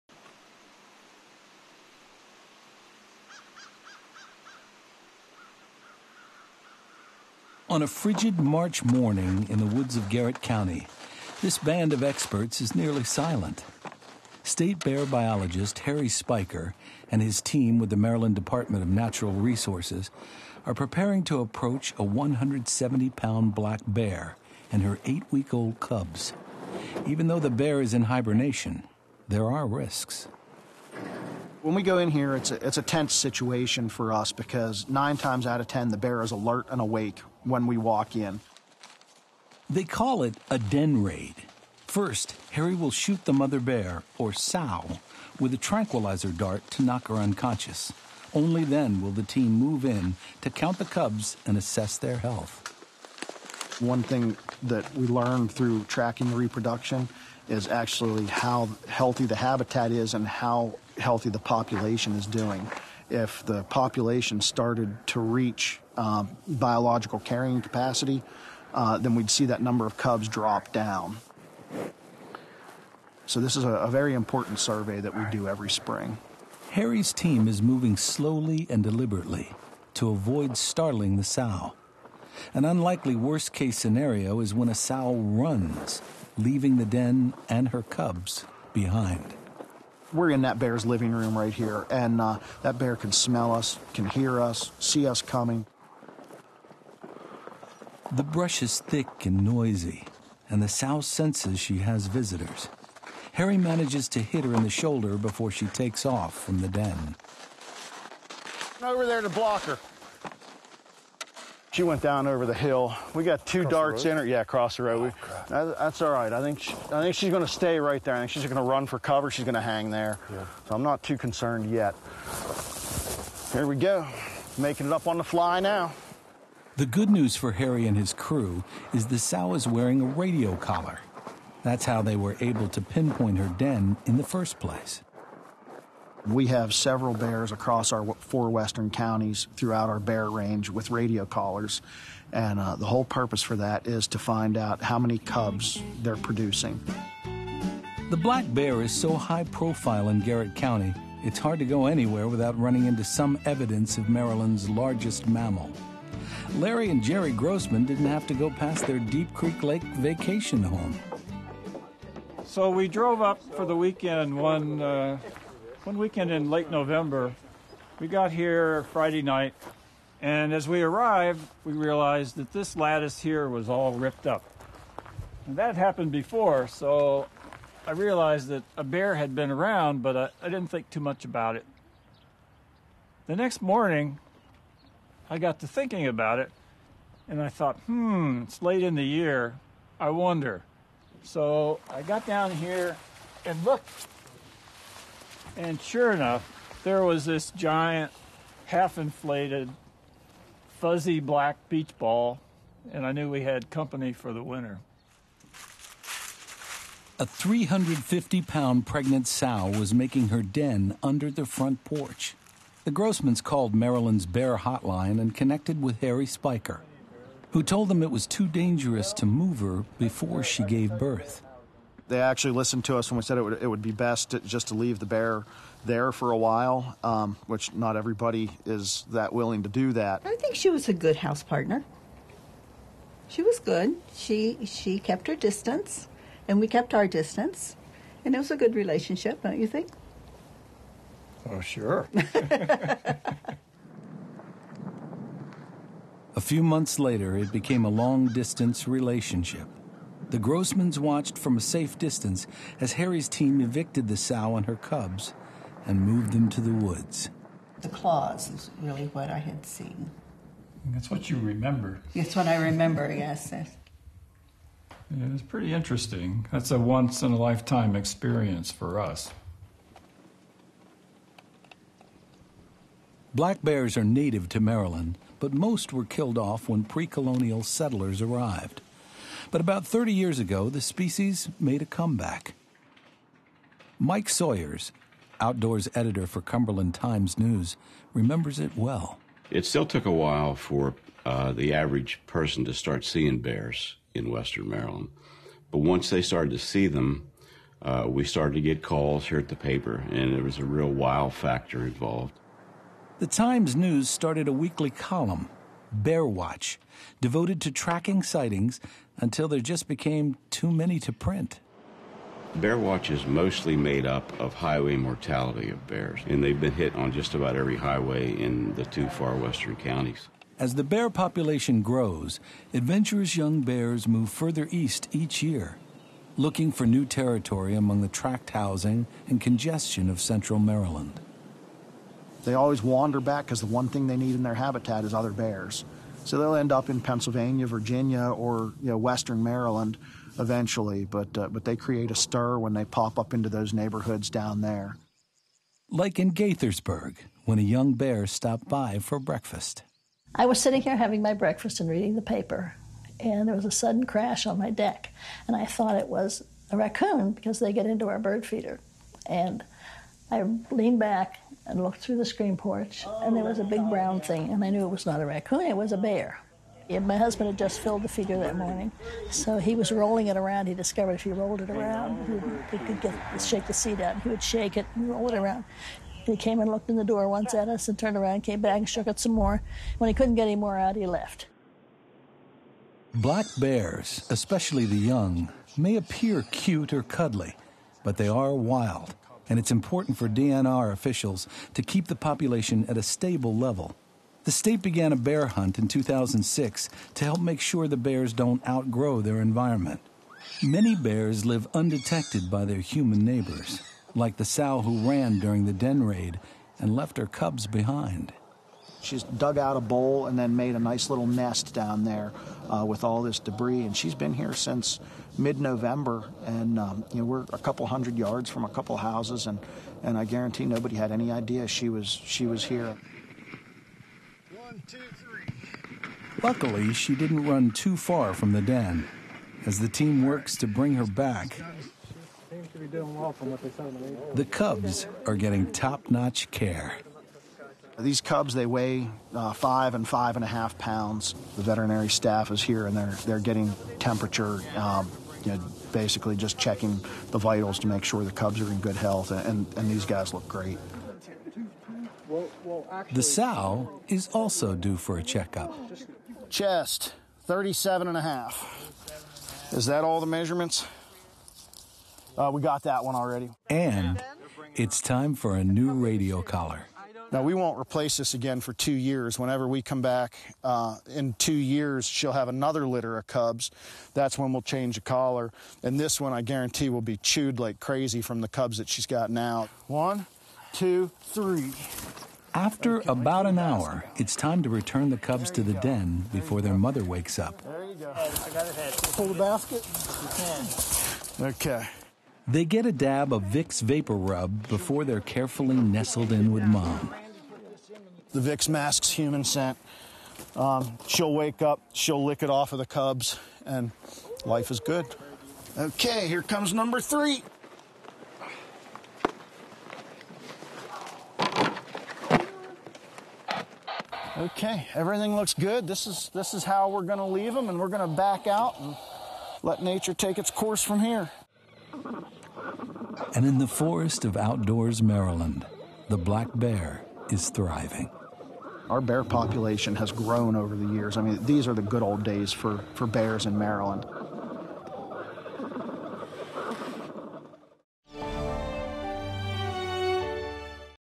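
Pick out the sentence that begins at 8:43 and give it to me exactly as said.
And in the forest of outdoors, Maryland, the black bear is thriving.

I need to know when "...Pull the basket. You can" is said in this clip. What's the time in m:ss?
8:09.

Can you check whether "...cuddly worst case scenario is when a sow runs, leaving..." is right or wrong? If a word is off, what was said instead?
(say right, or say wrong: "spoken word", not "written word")
wrong: "unlikely", not "cuddly".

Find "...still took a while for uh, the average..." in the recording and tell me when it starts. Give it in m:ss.
4:49.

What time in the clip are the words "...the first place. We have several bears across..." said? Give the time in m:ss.
2:14.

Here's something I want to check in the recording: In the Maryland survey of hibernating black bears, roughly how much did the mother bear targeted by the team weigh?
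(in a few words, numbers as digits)
170 pounds.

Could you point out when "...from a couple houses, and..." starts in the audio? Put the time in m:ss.
6:58.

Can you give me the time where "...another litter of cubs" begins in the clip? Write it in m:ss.
7:52.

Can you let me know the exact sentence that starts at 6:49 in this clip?
She's dug out a bowl and then made a nice little nest down there uh, with all this debris.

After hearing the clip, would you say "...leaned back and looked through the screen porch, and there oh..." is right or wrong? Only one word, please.
right.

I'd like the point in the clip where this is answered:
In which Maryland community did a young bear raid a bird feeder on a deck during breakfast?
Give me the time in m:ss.
5:46.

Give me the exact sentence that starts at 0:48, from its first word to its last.
Only then will the team move in to count the cubs and assess their health.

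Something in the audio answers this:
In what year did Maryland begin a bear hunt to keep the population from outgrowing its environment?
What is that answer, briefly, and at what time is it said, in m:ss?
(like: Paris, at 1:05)
2006, at 6:35.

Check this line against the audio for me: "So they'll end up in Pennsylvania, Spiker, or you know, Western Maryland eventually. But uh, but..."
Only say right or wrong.
wrong.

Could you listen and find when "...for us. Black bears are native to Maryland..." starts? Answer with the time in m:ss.
4:28.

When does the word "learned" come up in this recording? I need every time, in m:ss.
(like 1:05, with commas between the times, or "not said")
0:55.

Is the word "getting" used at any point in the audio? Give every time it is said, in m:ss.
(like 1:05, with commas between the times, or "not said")
7:15, 7:23.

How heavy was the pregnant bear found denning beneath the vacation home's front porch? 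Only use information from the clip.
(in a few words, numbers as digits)
350 pounds.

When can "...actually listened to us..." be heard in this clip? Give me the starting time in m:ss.
3:42.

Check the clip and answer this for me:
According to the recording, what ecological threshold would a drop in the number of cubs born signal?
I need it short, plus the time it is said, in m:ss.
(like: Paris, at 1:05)
biological carrying capacity, at 1:06.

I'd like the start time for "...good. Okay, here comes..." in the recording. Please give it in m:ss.
8:24.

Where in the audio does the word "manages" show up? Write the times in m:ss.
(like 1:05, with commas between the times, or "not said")
1:43.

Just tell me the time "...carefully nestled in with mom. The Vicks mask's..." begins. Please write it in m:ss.
8:15.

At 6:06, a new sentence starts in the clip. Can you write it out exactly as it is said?
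And my husband had just filled the feeder that morning, so he was rolling it around.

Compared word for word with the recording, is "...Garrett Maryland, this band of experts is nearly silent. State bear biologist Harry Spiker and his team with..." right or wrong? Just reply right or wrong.
wrong.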